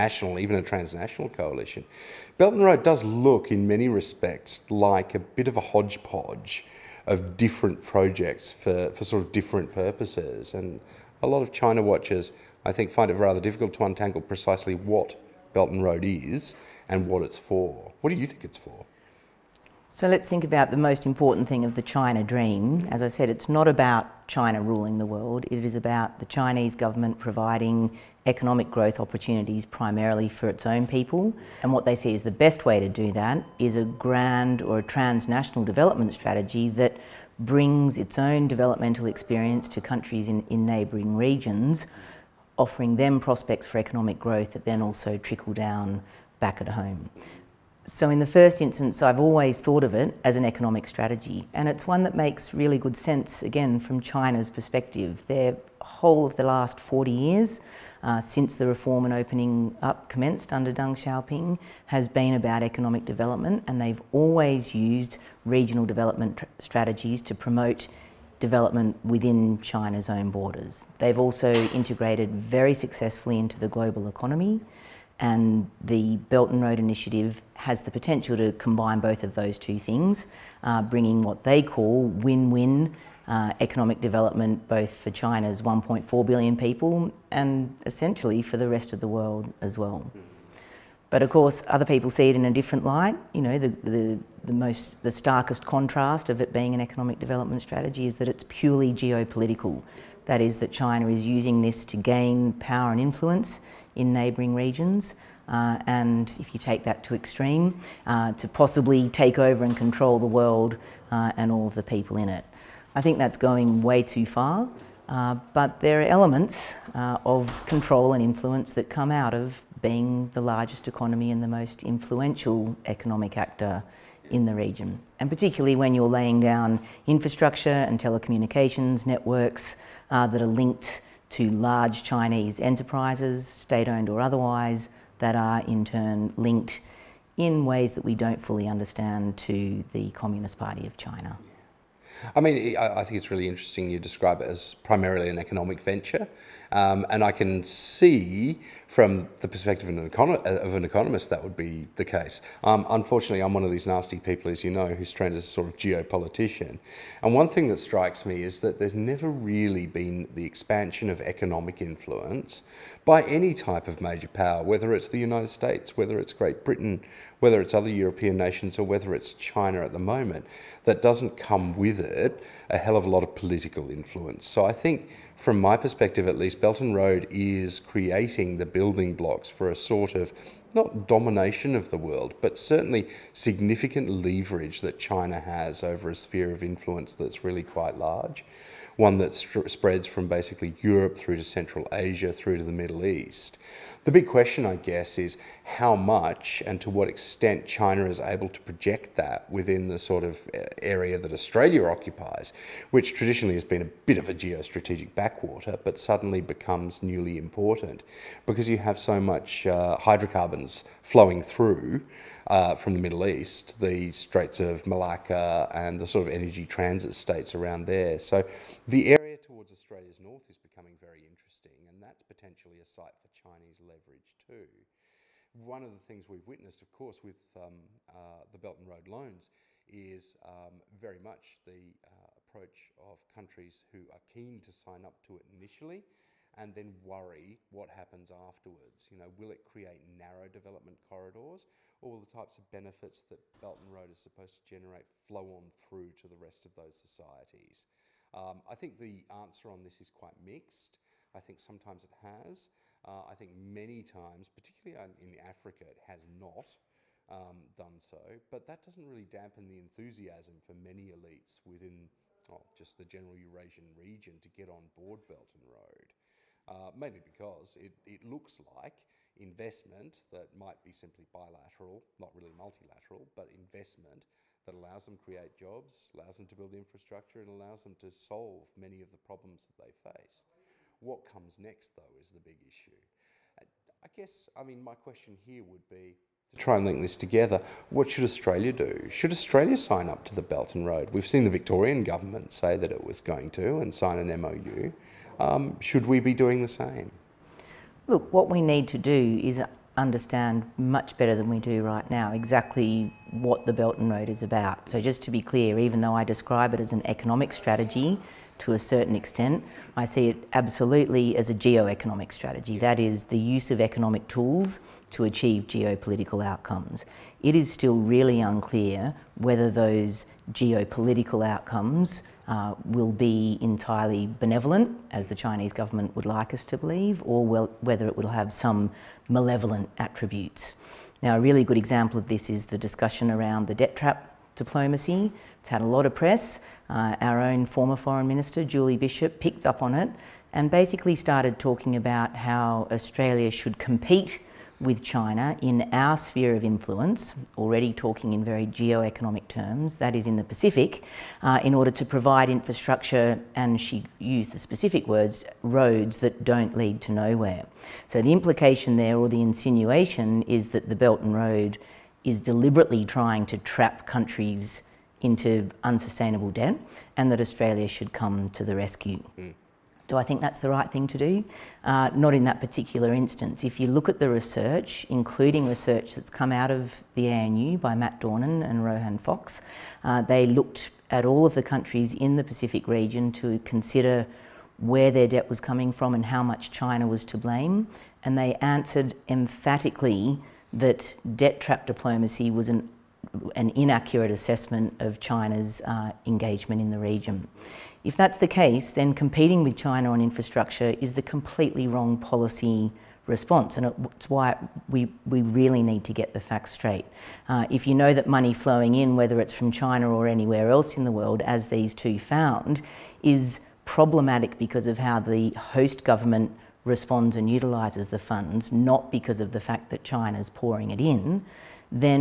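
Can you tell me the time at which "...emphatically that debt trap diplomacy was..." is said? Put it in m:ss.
6:29.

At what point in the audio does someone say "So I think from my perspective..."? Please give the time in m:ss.
2:54.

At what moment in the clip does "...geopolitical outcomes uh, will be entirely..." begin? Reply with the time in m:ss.
5:20.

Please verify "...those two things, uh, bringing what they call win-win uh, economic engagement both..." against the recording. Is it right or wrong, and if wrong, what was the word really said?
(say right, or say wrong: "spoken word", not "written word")
wrong: "development", not "engagement".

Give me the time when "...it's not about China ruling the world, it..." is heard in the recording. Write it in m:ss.
0:23.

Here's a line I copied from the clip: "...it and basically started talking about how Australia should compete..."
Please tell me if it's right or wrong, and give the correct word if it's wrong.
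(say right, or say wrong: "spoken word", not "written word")
right.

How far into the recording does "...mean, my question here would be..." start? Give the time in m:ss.
4:44.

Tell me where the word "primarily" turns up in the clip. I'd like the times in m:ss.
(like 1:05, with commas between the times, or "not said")
0:29, 2:24.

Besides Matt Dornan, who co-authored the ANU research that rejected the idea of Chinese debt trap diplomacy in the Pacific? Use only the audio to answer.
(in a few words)
Rohan Fox.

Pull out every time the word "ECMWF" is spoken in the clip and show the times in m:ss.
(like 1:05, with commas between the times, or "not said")
not said.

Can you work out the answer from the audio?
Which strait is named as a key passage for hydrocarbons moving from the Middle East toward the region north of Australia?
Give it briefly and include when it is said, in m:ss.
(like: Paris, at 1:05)
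Straits of Malacca, at 3:34.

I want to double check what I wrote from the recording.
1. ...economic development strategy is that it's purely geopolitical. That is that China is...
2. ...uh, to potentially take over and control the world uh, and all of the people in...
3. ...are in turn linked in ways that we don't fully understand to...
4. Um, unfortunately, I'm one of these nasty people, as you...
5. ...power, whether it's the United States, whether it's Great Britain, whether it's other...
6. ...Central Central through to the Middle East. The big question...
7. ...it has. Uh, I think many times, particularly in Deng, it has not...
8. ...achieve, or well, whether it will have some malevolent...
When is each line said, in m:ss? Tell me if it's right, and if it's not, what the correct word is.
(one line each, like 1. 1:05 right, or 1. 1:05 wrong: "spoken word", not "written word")
1. 1:36 right
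2. 1:48 wrong: "possibly", not "potentially"
3. 2:15 right
4. 2:32 right
5. 2:44 right
6. 3:11 wrong: "Asia", not "Central"
7. 4:12 wrong: "Africa", not "Deng"
8. 5:26 wrong: "believe", not "achieve".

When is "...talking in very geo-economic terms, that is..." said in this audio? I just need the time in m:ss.
5:47.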